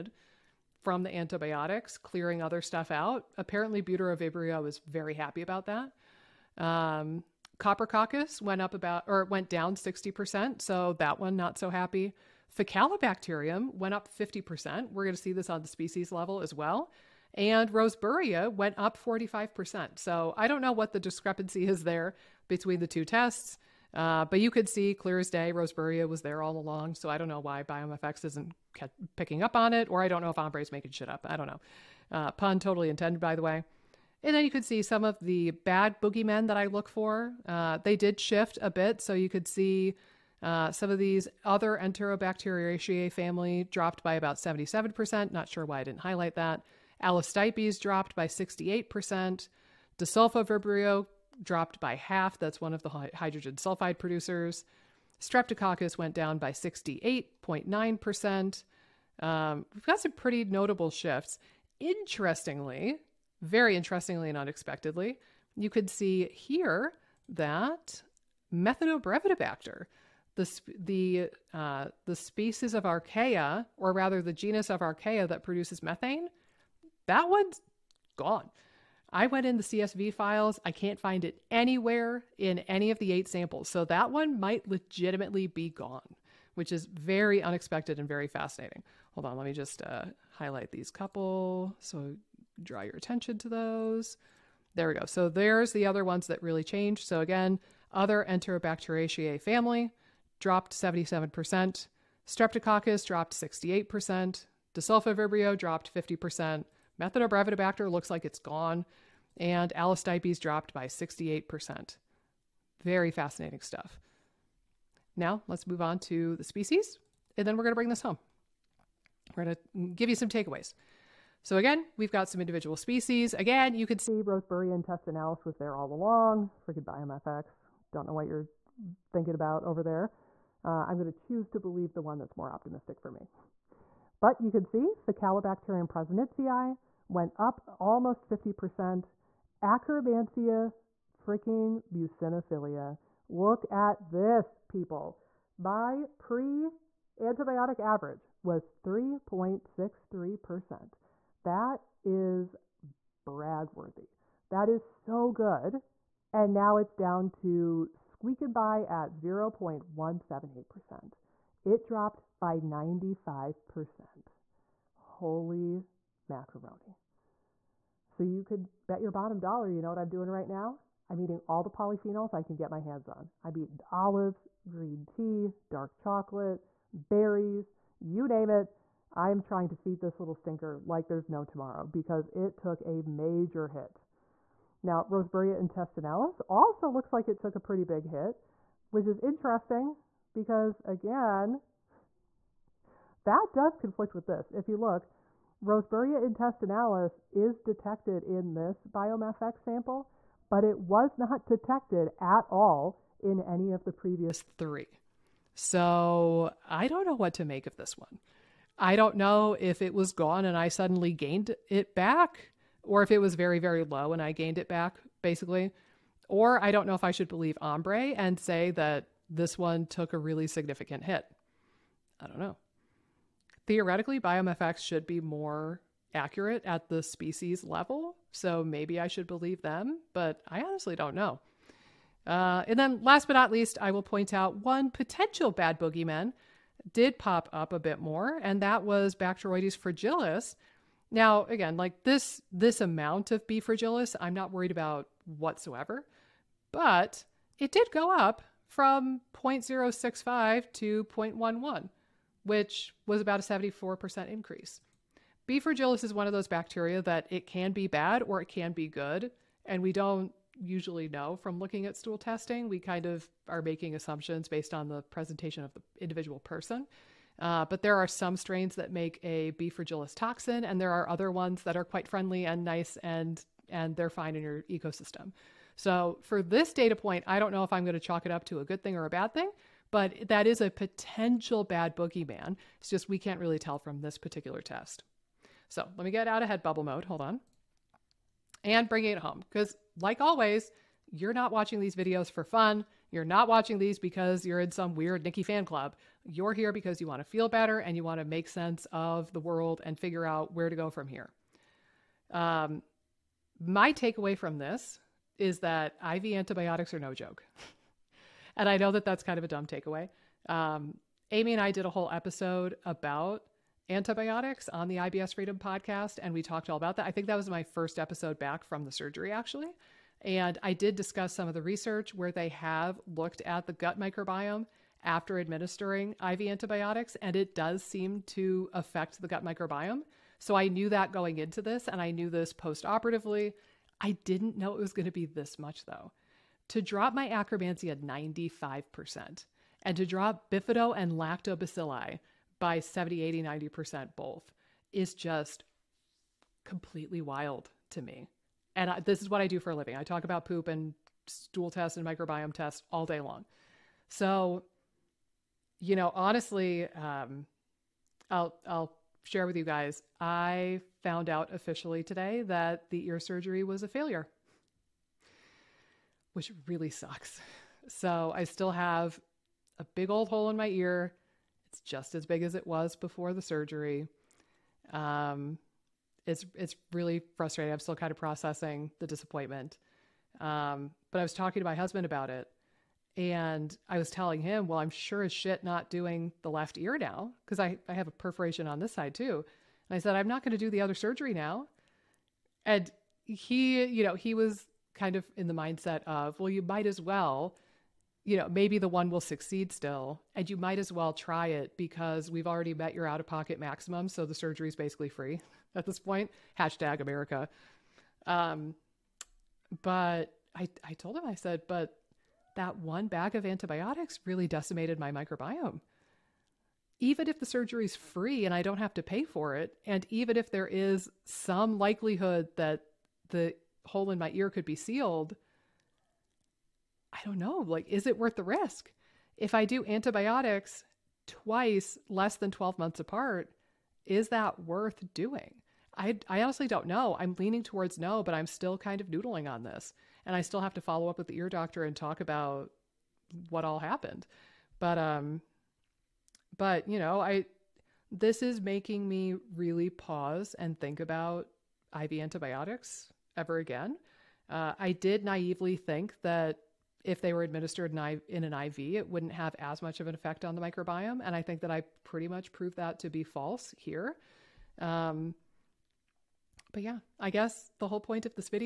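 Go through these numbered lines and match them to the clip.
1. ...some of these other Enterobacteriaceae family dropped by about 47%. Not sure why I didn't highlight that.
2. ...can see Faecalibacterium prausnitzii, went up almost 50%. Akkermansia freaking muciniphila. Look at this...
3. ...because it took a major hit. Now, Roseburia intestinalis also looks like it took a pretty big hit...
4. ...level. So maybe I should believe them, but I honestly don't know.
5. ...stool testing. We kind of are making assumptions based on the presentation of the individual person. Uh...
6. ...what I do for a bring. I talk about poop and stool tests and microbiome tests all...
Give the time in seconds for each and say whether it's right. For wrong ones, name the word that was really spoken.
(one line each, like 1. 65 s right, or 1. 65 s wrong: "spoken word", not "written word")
1. 40 s wrong: "77", not "47"
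2. 134 s right
3. 181 s right
4. 227 s right
5. 261 s right
6. 349 s wrong: "living", not "bring".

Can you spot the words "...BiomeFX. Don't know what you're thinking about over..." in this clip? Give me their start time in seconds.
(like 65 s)
126 s.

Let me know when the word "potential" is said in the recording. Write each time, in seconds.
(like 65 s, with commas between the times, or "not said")
234 s, 280 s.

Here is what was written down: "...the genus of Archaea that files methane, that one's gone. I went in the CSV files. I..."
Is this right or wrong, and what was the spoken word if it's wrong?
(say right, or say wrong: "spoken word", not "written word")
wrong: "produces", not "files".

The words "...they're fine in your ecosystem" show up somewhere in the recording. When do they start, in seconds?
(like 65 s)
273 s.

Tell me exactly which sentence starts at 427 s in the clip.
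Like, is it worth the risk?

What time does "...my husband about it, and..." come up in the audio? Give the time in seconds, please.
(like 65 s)
381 s.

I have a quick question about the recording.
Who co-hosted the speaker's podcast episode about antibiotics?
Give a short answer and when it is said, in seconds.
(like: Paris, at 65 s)
Amy, at 311 s.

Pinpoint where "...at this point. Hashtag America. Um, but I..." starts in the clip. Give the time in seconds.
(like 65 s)
405 s.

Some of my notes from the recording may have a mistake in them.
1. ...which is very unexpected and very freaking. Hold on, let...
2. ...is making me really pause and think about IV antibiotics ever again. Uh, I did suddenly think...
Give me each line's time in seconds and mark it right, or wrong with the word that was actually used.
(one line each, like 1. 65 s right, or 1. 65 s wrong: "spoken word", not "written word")
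1. 86 s wrong: "fascinating", not "freaking"
2. 448 s wrong: "naively", not "suddenly".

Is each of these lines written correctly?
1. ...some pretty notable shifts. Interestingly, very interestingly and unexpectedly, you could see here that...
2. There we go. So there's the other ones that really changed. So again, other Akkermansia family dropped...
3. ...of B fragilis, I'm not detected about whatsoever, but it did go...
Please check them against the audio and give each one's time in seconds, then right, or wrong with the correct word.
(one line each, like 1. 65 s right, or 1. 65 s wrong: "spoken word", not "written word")
1. 59 s right
2. 94 s wrong: "Enterobacteriaceae", not "Akkermansia"
3. 243 s wrong: "worried", not "detected".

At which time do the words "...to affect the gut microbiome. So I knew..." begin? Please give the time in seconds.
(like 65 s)
328 s.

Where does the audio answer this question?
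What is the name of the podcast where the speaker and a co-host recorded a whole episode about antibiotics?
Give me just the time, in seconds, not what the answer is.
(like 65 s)
314 s.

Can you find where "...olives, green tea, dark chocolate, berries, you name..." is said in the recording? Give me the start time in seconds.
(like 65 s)
173 s.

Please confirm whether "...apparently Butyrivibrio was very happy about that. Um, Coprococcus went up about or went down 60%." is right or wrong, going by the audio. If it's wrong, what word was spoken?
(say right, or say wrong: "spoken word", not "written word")
right.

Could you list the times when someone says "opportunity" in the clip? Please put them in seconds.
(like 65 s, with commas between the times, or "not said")
not said.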